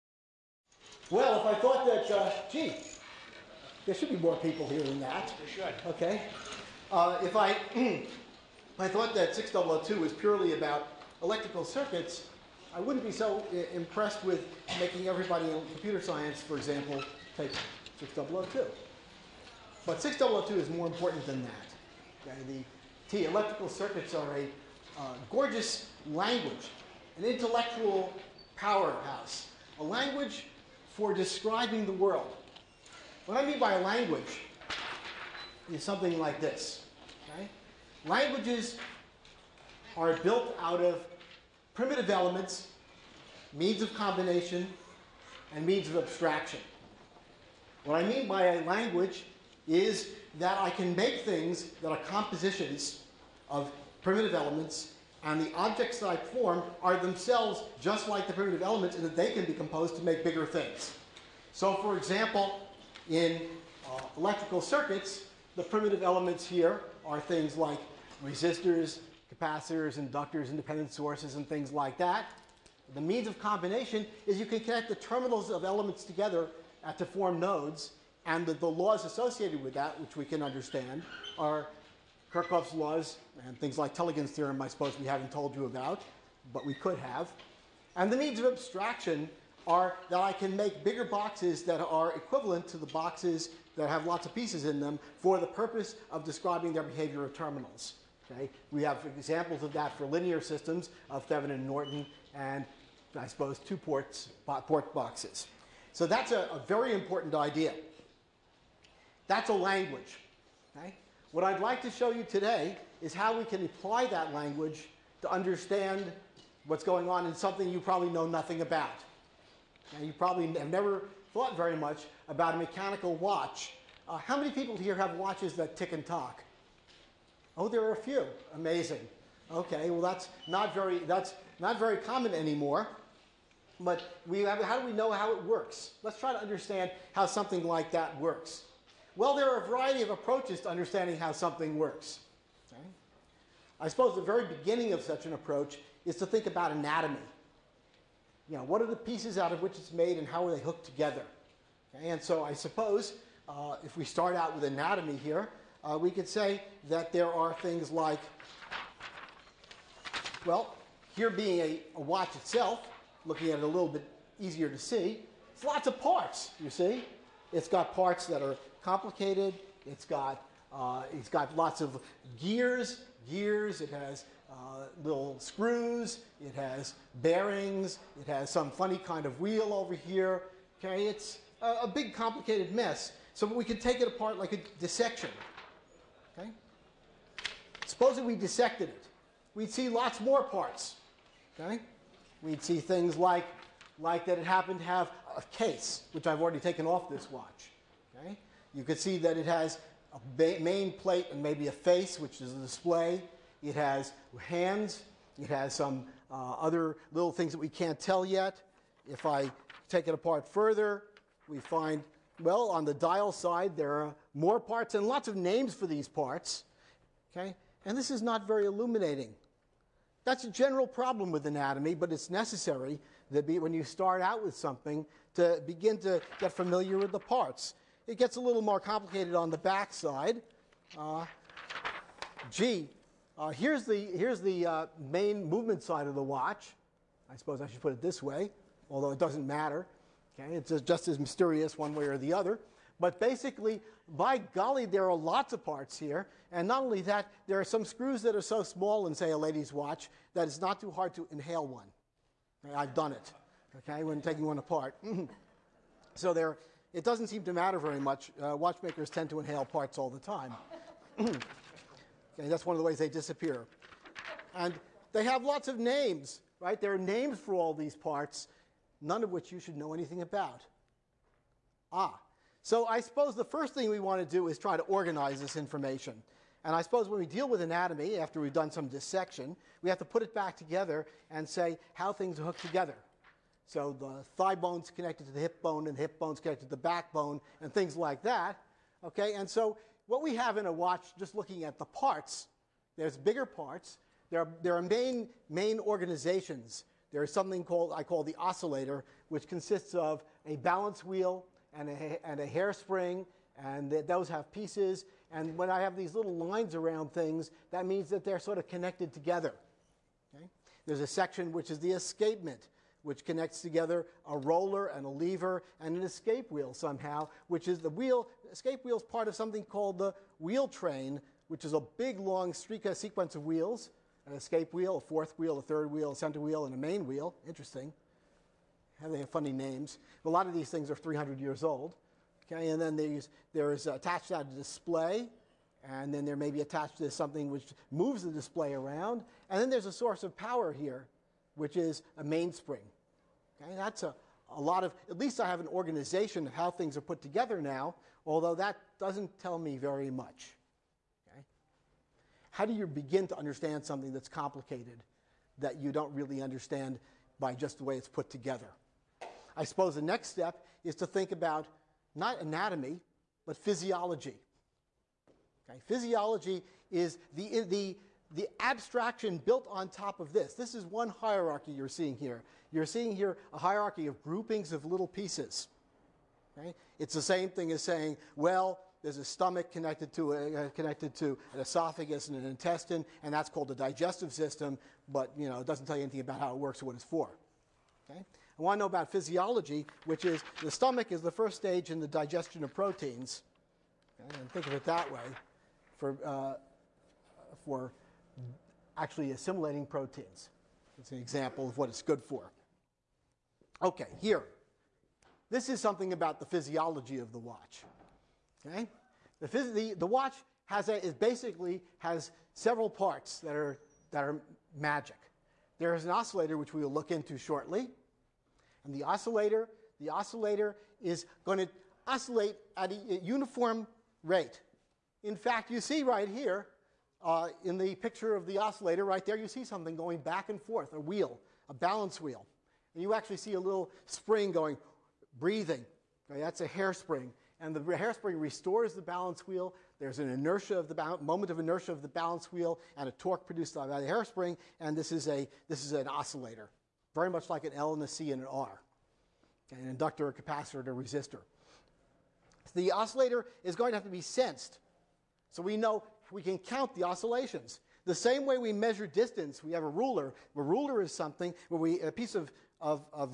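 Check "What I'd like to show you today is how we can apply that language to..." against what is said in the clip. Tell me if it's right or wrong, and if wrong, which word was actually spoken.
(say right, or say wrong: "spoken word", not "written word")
right.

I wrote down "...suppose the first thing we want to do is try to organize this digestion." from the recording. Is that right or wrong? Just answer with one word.
wrong.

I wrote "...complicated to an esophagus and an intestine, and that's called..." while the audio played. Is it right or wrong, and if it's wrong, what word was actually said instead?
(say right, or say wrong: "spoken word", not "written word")
wrong: "connected", not "complicated".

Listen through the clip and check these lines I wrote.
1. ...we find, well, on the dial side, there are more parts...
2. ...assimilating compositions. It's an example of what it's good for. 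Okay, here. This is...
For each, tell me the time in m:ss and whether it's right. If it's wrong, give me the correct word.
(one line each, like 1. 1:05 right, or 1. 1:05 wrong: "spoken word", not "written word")
1. 3:31 right
2. 6:39 wrong: "proteins", not "compositions".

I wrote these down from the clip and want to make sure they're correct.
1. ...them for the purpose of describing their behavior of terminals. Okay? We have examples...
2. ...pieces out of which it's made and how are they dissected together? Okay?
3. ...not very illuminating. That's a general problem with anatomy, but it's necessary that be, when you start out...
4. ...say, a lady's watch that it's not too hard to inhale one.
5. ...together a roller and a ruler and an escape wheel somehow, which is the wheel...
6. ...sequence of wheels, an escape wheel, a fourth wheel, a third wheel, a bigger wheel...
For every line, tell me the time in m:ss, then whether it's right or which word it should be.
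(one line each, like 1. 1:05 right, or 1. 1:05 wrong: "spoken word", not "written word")
1. 1:34 right
2. 2:28 wrong: "hooked", not "dissected"
3. 3:38 right
4. 4:09 right
5. 5:13 wrong: "lever", not "ruler"
6. 5:22 wrong: "center", not "bigger".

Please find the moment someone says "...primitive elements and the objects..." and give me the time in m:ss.
0:54.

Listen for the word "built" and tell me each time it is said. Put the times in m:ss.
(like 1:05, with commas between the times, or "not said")
0:40, 6:09.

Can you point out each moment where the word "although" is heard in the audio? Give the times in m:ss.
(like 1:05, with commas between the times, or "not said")
3:58, 5:48.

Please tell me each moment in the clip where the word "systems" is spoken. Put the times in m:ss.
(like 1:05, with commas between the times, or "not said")
1:40, 6:24.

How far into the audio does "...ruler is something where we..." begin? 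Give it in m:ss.
7:40.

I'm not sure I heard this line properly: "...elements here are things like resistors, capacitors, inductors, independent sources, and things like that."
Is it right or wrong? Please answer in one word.
right.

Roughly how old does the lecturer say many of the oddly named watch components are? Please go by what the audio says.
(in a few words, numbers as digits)
300 years.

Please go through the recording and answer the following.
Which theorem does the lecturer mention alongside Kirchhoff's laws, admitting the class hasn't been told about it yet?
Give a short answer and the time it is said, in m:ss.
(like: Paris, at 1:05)
Tellegen's theorem, at 1:23.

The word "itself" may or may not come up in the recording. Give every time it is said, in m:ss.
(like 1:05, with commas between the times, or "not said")
2:42.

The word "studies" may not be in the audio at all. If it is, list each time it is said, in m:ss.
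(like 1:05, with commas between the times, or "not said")
not said.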